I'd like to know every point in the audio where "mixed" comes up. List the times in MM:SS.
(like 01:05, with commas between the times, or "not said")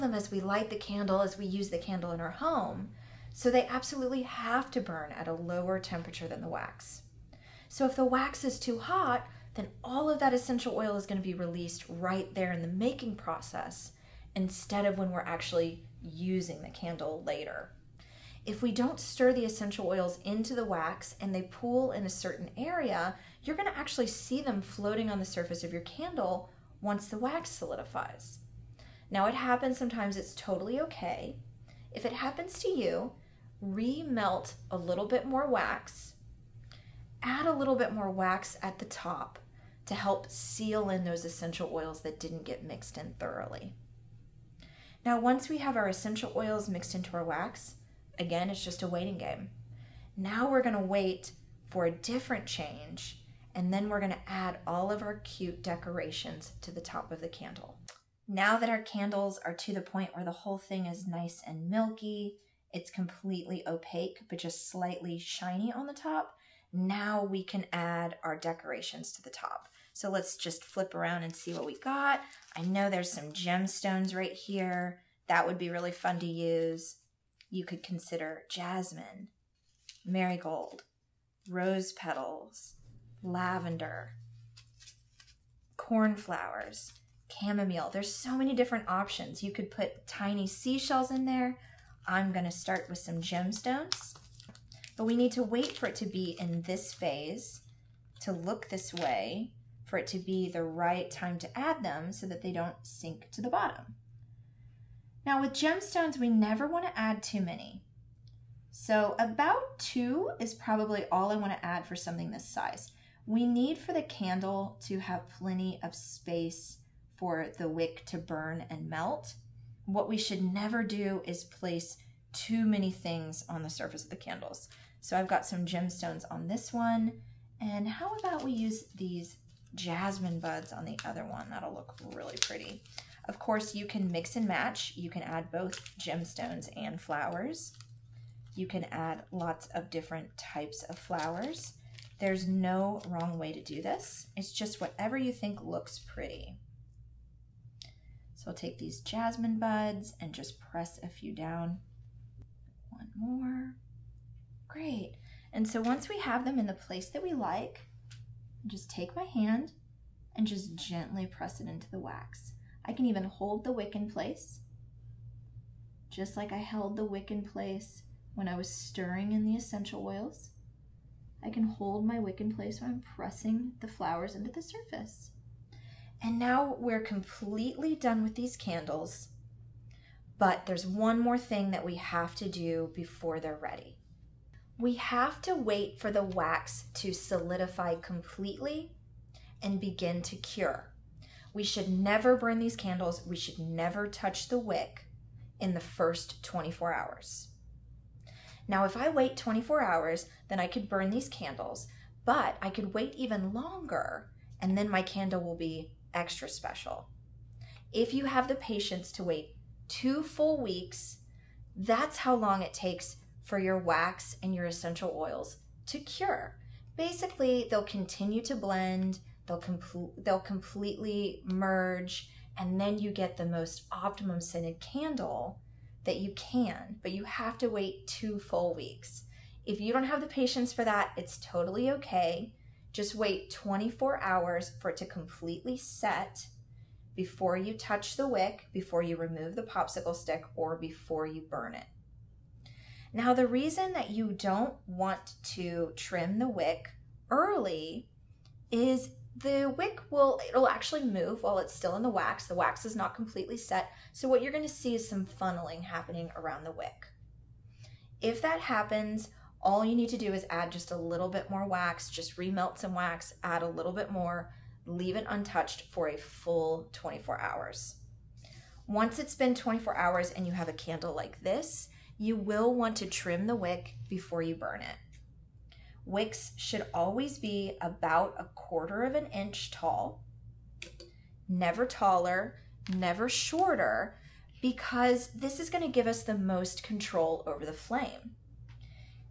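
00:42, 00:46.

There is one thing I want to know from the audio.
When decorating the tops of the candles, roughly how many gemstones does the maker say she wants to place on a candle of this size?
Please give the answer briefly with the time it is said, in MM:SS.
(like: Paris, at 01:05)
2, at 01:49.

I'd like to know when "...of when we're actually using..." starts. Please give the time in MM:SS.
00:14.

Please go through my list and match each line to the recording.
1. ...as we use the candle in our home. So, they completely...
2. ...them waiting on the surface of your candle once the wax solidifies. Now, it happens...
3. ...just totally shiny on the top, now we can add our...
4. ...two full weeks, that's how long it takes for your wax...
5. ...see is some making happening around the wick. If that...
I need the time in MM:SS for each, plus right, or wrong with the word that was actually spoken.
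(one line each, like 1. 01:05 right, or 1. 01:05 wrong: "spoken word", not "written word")
1. 00:01 wrong: "absolutely", not "completely"
2. 00:24 wrong: "floating", not "waiting"
3. 01:04 wrong: "slightly", not "totally"
4. 03:29 right
5. 04:14 wrong: "funneling", not "making".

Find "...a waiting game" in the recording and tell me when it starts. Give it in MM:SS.
00:48.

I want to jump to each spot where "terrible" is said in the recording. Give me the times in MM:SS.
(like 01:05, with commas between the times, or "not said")
not said.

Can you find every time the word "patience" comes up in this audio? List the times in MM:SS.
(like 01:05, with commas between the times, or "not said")
03:28, 03:50.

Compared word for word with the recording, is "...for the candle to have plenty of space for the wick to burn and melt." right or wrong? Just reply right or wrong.
right.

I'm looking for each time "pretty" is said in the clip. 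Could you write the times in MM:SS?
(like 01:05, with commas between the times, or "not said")
02:12, 02:25.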